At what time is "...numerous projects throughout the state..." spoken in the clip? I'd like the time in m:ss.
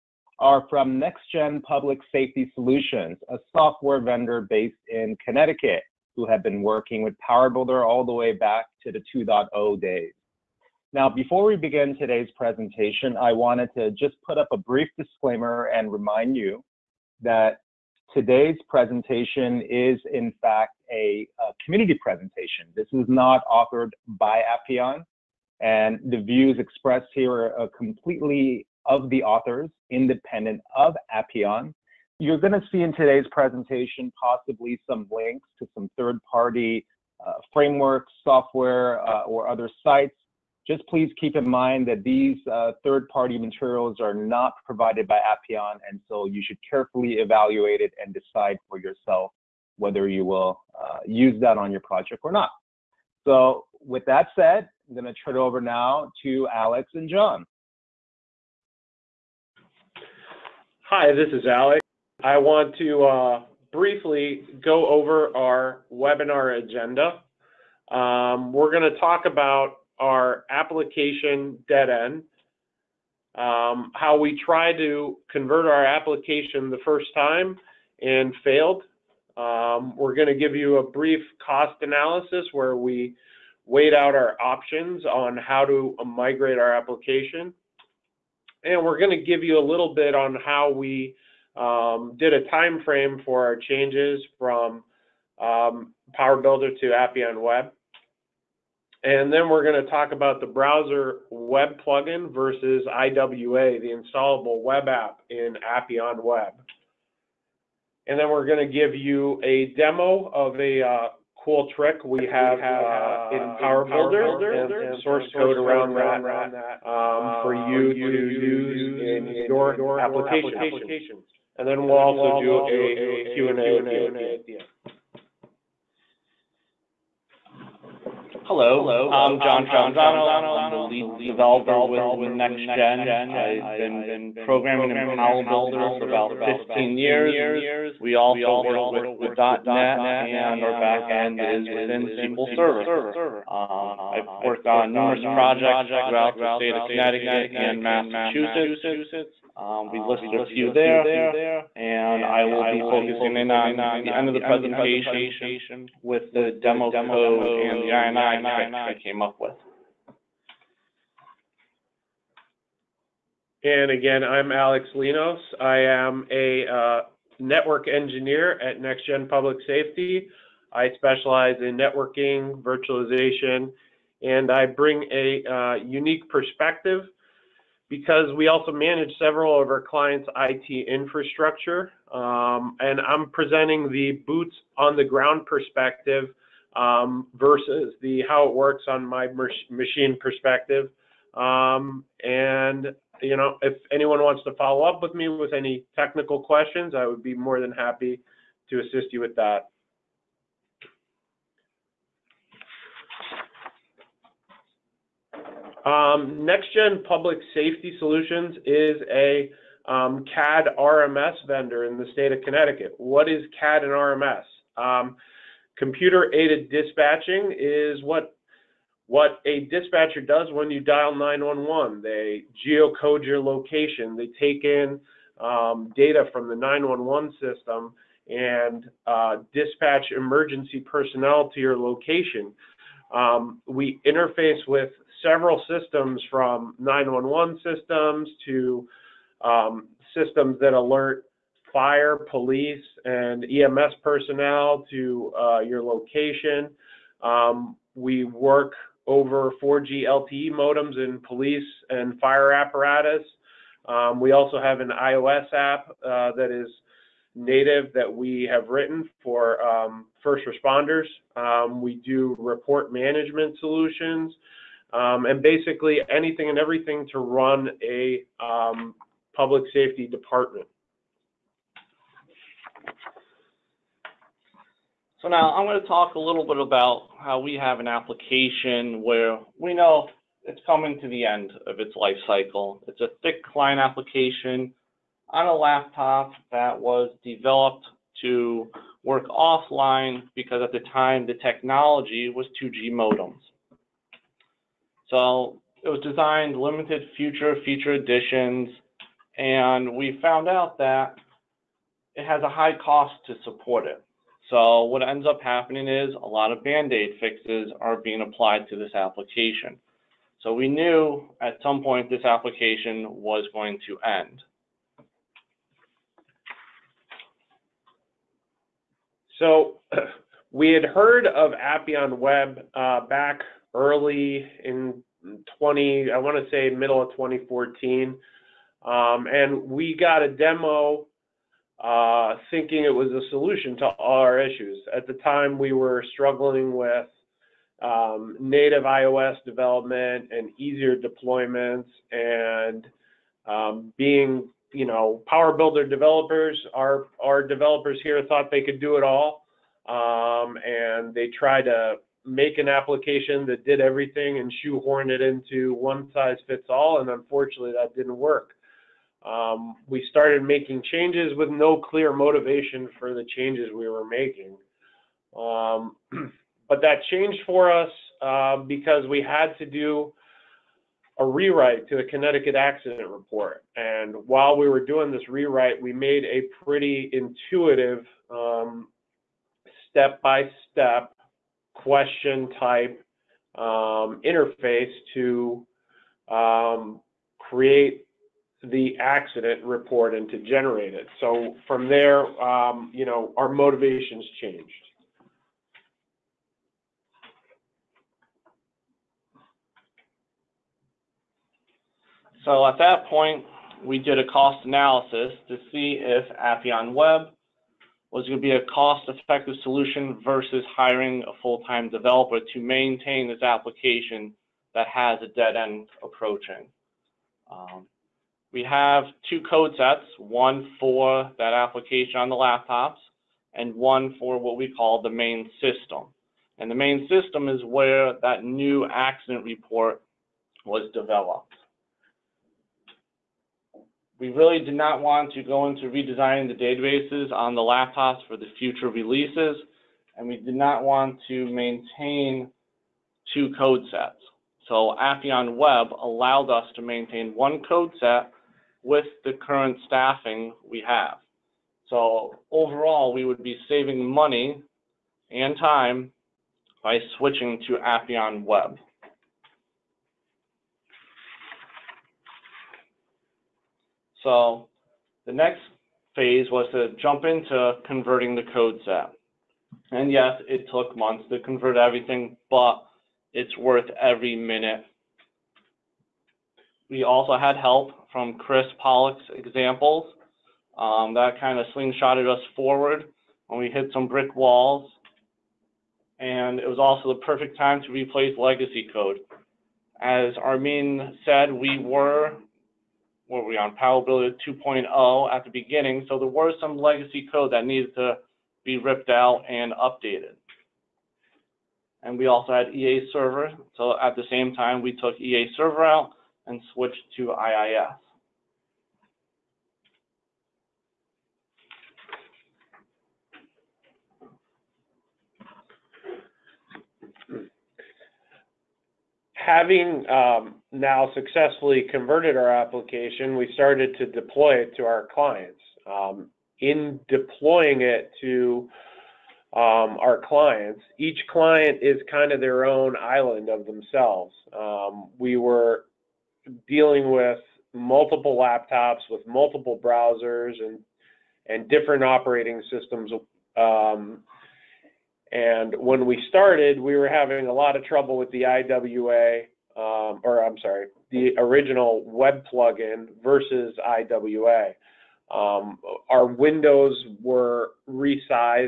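2:24.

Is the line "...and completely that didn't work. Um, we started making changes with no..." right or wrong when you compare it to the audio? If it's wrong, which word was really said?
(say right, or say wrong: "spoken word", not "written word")
wrong: "unfortunately", not "completely".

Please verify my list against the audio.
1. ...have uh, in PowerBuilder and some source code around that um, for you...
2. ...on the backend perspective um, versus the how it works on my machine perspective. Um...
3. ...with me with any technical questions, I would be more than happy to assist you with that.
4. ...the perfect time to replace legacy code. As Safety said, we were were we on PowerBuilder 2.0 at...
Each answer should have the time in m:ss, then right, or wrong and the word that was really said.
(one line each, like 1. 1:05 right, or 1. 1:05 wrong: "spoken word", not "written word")
1. 1:52 right
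2. 3:04 wrong: "ground", not "backend"
3. 3:15 right
4. 8:07 wrong: "Armeen", not "Safety".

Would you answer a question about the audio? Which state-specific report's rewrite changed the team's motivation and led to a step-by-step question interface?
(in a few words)
Connecticut accident report.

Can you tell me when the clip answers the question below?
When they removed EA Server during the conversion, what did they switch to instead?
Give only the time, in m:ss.
8:27.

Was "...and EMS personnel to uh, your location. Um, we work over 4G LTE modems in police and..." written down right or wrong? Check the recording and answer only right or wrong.
right.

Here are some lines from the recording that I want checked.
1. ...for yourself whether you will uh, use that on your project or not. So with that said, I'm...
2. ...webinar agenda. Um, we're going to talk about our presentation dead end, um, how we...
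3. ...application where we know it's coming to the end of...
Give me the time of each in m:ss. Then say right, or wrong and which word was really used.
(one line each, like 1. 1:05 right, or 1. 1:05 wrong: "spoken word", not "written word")
1. 0:48 right
2. 1:05 wrong: "application", not "presentation"
3. 4:37 right.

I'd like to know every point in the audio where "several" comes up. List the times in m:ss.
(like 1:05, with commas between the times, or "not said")
2:59, 3:55.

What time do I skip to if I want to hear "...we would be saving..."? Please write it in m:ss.
7:33.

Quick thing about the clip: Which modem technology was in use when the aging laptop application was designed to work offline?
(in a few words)
2G modems.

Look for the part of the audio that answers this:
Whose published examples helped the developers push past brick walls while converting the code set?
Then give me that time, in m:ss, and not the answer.
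7:58.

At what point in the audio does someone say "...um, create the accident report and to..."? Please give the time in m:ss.
6:26.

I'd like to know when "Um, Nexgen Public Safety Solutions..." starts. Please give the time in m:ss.
3:25.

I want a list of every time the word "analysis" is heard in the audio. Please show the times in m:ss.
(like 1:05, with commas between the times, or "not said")
1:21, 6:44.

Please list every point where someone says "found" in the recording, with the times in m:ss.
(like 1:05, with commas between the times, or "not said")
5:00.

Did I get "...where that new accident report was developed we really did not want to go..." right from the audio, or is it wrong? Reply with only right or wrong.
right.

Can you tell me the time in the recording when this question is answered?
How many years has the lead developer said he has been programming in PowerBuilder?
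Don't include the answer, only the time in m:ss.
2:16.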